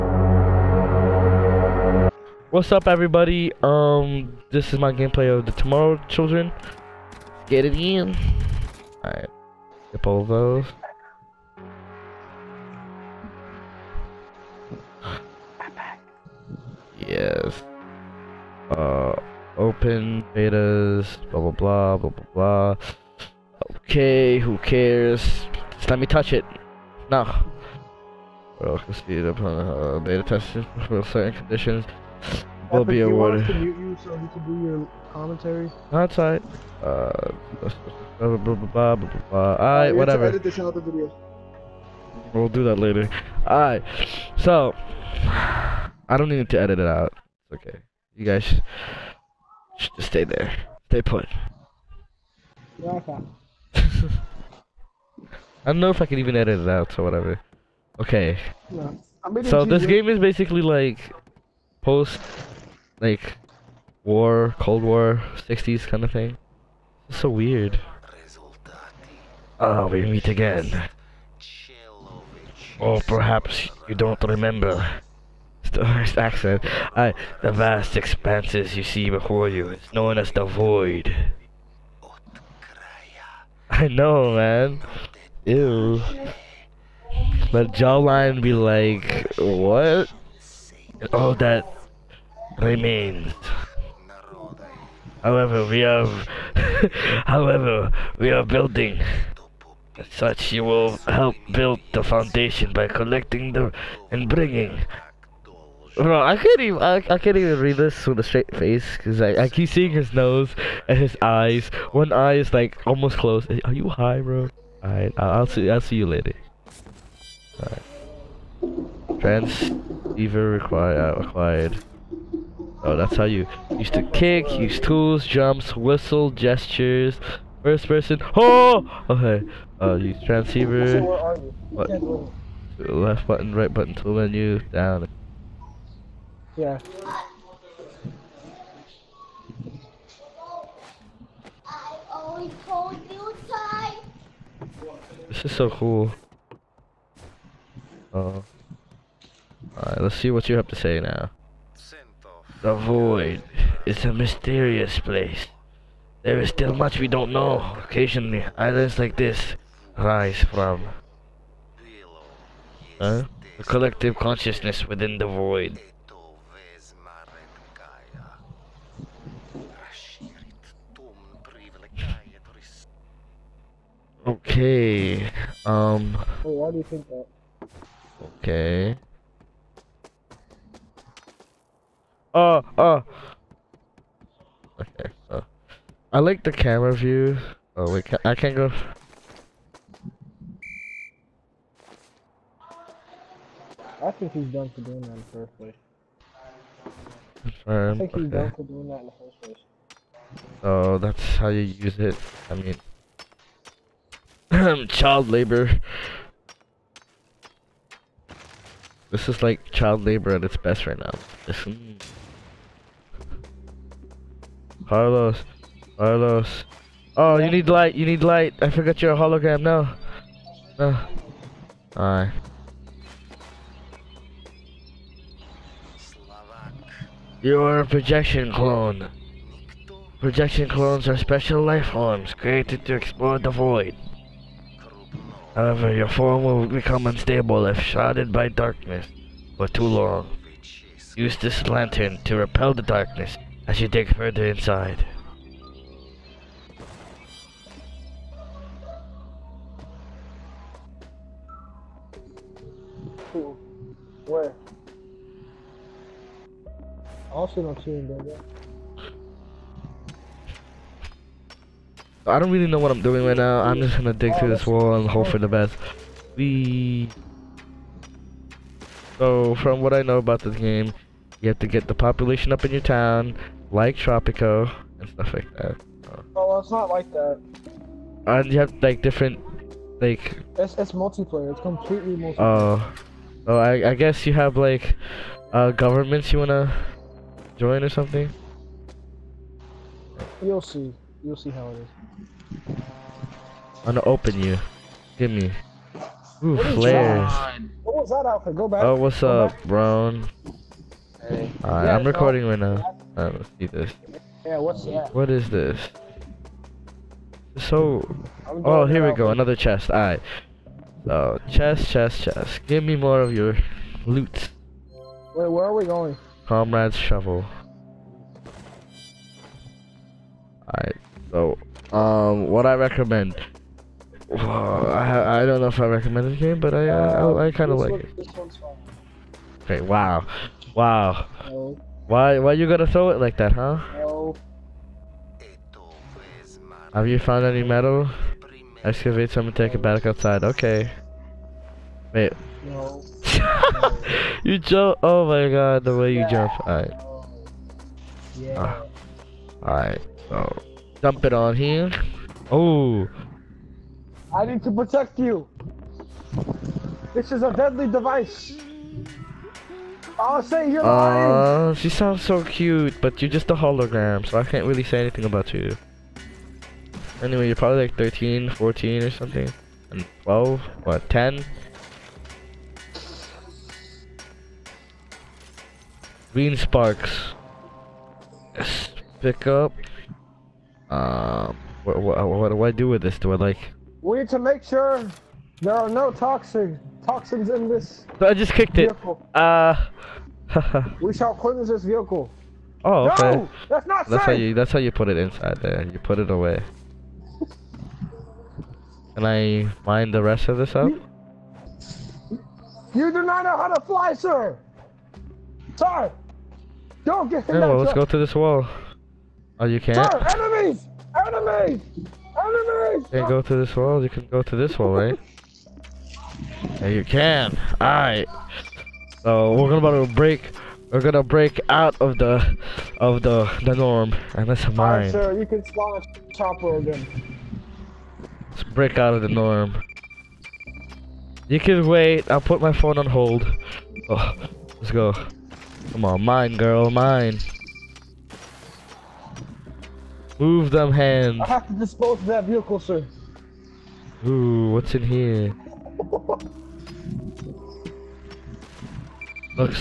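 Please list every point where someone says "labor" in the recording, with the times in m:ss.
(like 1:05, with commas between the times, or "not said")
3:25, 3:30.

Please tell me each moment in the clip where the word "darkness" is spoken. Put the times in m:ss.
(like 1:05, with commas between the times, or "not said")
3:58, 4:02.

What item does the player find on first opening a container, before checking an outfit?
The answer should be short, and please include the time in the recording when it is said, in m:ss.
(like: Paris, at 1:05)
Flares, at 4:56.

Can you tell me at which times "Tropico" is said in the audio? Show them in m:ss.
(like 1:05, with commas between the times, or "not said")
4:33.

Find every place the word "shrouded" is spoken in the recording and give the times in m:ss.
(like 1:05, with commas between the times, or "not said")
3:57.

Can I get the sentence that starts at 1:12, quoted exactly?
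Or oh, perhaps you don't remember.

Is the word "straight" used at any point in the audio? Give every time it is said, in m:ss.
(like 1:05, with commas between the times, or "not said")
1:48.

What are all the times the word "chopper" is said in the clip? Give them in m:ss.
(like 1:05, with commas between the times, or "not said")
7:06.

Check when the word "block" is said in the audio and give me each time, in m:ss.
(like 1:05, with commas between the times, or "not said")
not said.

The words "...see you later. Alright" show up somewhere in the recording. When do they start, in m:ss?
1:55.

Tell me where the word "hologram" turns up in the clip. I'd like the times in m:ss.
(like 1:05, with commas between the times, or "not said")
3:39, 6:03.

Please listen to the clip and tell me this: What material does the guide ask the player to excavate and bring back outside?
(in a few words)
Metal.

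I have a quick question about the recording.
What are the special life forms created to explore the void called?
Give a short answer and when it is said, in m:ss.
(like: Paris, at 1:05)
Projection clones, at 3:50.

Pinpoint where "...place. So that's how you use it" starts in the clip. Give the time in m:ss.
3:19.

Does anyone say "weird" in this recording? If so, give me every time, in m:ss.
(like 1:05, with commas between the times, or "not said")
1:07.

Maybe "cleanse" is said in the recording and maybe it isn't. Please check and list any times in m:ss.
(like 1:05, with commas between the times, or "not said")
6:31.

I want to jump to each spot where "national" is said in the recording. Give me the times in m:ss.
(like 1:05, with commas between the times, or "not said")
not said.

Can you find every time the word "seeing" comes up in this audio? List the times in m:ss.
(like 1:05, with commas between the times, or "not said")
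1:49, 4:17.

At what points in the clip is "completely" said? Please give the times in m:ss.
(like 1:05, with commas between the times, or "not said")
4:41.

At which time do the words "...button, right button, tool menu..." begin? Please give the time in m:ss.
2:13.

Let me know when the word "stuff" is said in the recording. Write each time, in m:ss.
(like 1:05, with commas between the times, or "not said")
4:35.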